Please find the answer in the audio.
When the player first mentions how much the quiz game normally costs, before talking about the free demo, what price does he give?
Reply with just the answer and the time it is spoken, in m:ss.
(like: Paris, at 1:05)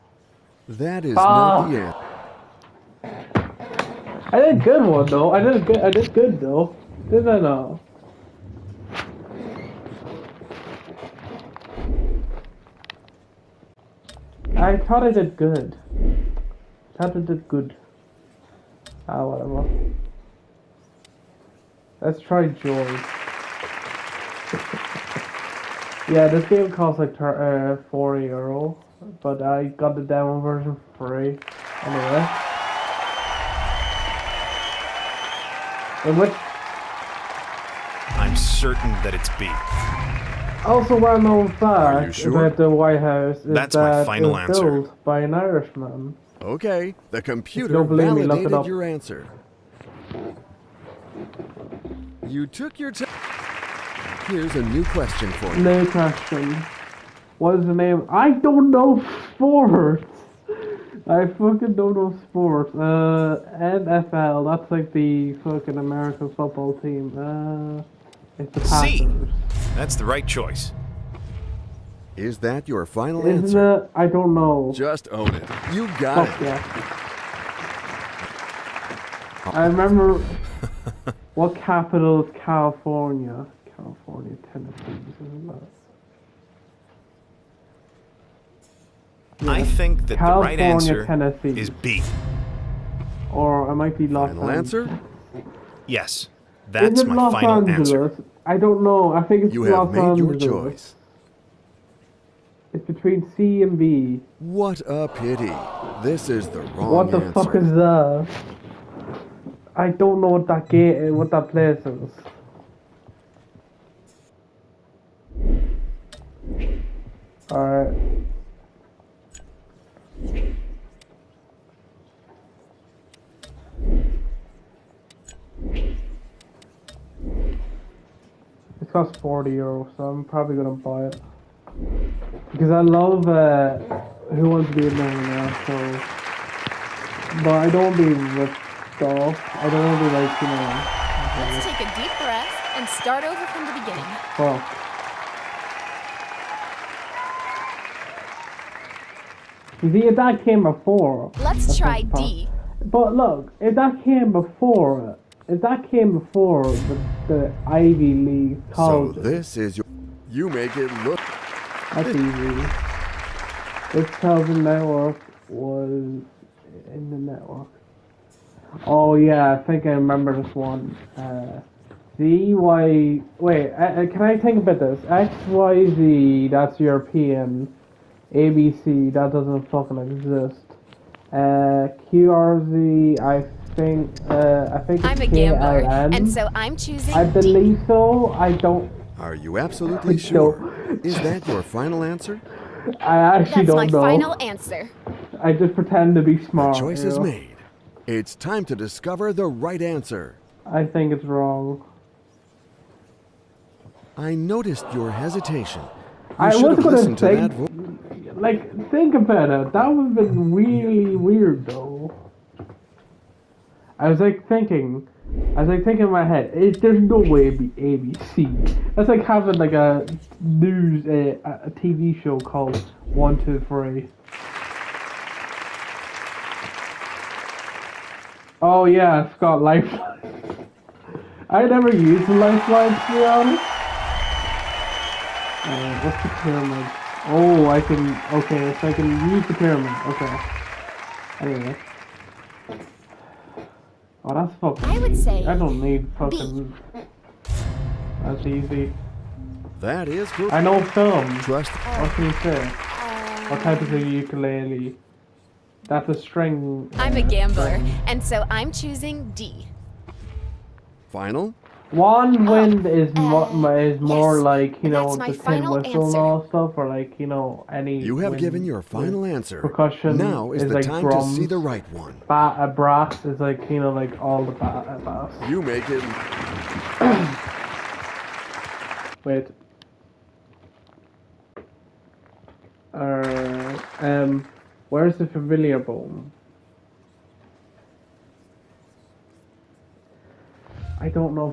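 4 euro, at 0:27.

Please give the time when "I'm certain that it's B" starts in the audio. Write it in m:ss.
0:38.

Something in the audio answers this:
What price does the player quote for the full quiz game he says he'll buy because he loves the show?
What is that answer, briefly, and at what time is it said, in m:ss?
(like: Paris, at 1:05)
40 euro, at 2:09.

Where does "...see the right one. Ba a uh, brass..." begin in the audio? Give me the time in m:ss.
4:31.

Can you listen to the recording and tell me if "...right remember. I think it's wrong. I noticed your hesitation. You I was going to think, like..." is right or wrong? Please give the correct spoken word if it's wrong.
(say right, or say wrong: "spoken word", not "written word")
wrong: "answer", not "remember".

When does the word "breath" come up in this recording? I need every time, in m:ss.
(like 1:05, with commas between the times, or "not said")
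2:22.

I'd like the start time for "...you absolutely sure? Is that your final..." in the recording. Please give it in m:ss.
3:09.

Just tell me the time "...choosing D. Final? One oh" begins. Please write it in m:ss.
4:18.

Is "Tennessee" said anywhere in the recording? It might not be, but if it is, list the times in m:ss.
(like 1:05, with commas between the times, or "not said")
1:24, 1:31.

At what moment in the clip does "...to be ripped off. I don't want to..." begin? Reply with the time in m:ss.
2:17.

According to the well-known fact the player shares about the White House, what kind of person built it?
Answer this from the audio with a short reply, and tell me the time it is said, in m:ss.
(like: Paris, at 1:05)
An Irishman, at 0:45.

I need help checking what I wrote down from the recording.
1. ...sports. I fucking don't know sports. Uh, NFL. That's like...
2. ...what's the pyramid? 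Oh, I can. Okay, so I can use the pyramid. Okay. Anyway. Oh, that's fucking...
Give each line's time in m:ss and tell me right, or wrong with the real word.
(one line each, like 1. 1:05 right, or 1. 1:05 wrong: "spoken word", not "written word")
1. 0:59 right
2. 3:56 right.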